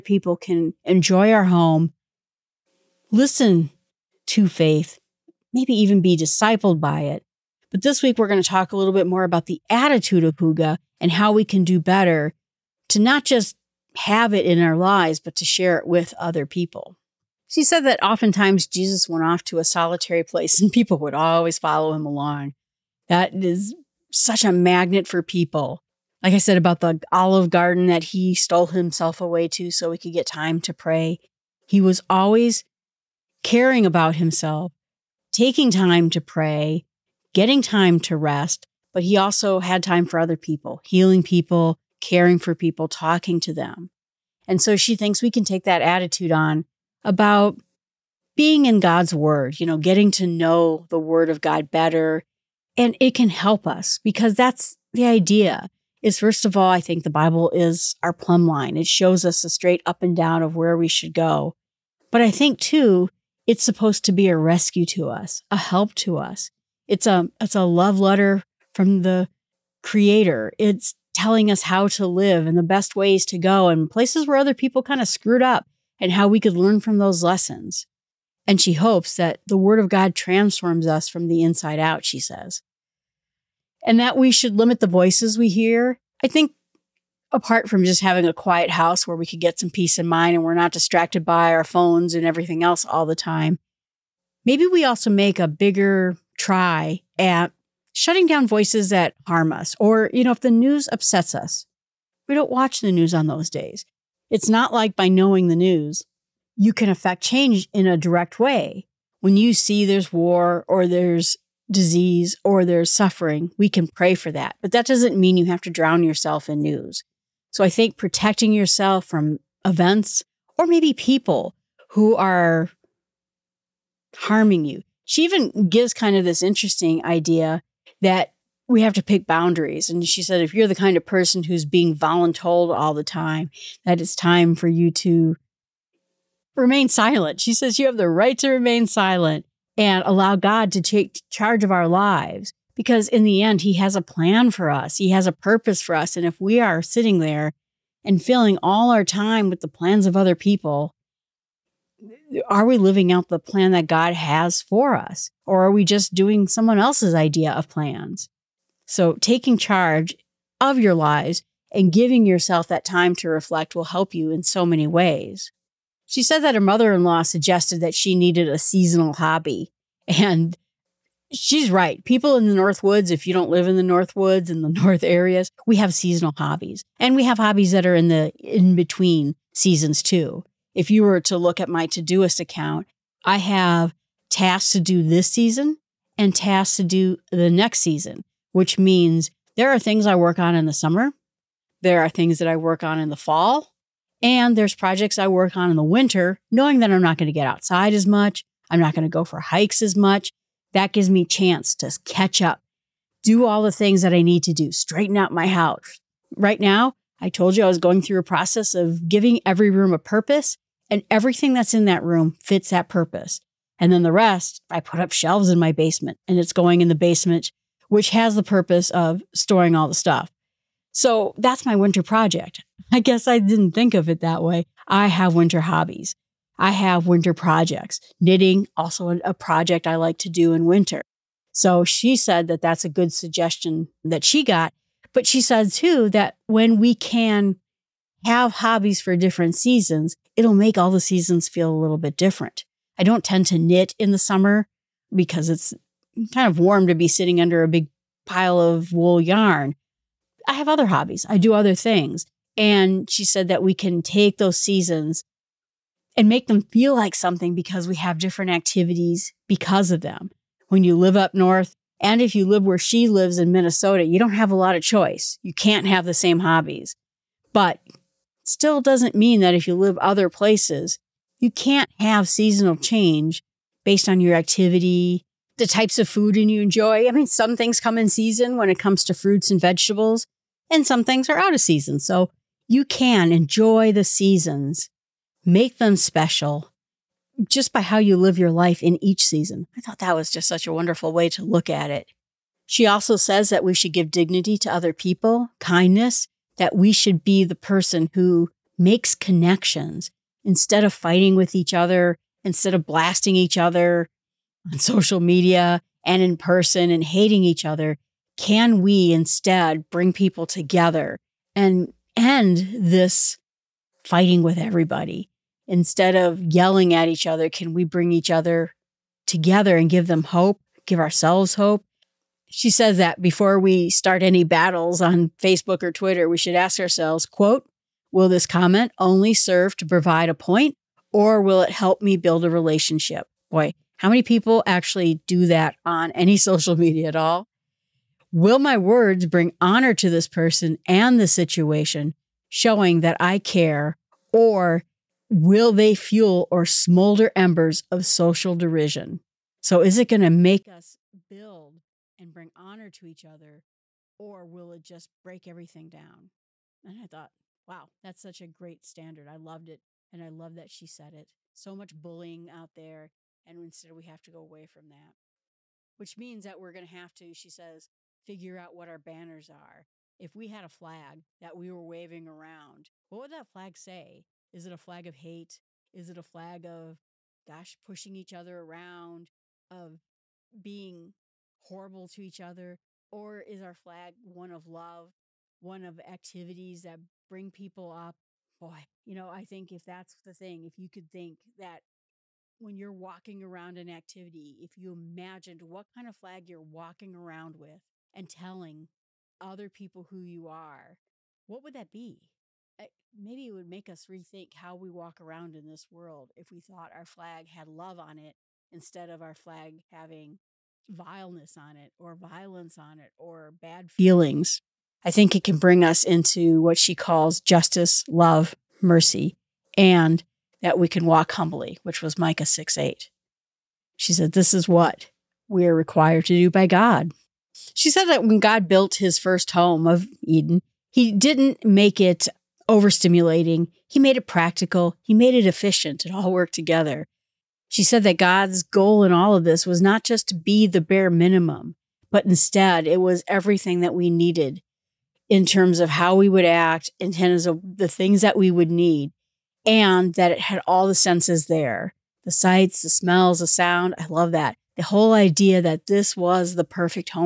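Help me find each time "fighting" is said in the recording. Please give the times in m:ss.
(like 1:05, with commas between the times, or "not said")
5:00, 5:14.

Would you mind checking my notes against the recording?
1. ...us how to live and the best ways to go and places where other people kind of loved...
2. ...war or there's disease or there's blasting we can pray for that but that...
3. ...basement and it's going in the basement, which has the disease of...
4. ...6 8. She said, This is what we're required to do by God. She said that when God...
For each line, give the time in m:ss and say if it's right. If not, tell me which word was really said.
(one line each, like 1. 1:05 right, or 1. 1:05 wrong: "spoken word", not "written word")
1. 1:11 wrong: "screwed", not "loved"
2. 1:50 wrong: "suffering", not "blasting"
3. 3:35 wrong: "purpose", not "disease"
4. 7:02 right.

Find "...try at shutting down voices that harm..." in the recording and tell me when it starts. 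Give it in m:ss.
1:36.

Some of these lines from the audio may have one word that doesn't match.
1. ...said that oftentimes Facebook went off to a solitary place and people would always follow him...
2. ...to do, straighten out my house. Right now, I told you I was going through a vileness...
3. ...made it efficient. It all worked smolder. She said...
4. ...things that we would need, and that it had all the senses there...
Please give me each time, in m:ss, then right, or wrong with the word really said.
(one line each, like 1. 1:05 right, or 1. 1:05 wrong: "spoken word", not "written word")
1. 0:17 wrong: "Jesus", not "Facebook"
2. 3:24 wrong: "process", not "vileness"
3. 7:15 wrong: "together", not "smolder"
4. 7:27 right.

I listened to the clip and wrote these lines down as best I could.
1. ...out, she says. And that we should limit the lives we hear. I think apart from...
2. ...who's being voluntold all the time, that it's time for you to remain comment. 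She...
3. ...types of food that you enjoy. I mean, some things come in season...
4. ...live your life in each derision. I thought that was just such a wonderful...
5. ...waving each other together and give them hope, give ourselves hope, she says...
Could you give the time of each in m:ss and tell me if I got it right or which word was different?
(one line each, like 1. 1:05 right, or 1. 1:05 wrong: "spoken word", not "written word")
1. 1:21 wrong: "voices", not "lives"
2. 2:11 wrong: "silent", not "comment"
3. 4:35 right
4. 4:48 wrong: "season", not "derision"
5. 5:17 wrong: "bring", not "waving".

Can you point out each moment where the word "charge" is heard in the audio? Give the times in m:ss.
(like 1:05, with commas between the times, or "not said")
2:21, 2:39.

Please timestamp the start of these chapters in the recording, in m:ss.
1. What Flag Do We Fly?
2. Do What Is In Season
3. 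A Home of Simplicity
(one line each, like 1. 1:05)
1. 4:51
2. 2:45
3. 7:06.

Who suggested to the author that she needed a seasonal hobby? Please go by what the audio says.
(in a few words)
her mother in law.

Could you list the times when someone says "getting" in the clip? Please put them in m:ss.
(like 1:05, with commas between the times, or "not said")
0:37, 0:49.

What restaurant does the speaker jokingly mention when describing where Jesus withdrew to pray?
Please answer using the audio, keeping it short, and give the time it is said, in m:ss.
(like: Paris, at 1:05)
Olive Garden, at 0:27.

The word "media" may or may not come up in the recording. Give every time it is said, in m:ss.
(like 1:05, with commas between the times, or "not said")
5:05, 5:36.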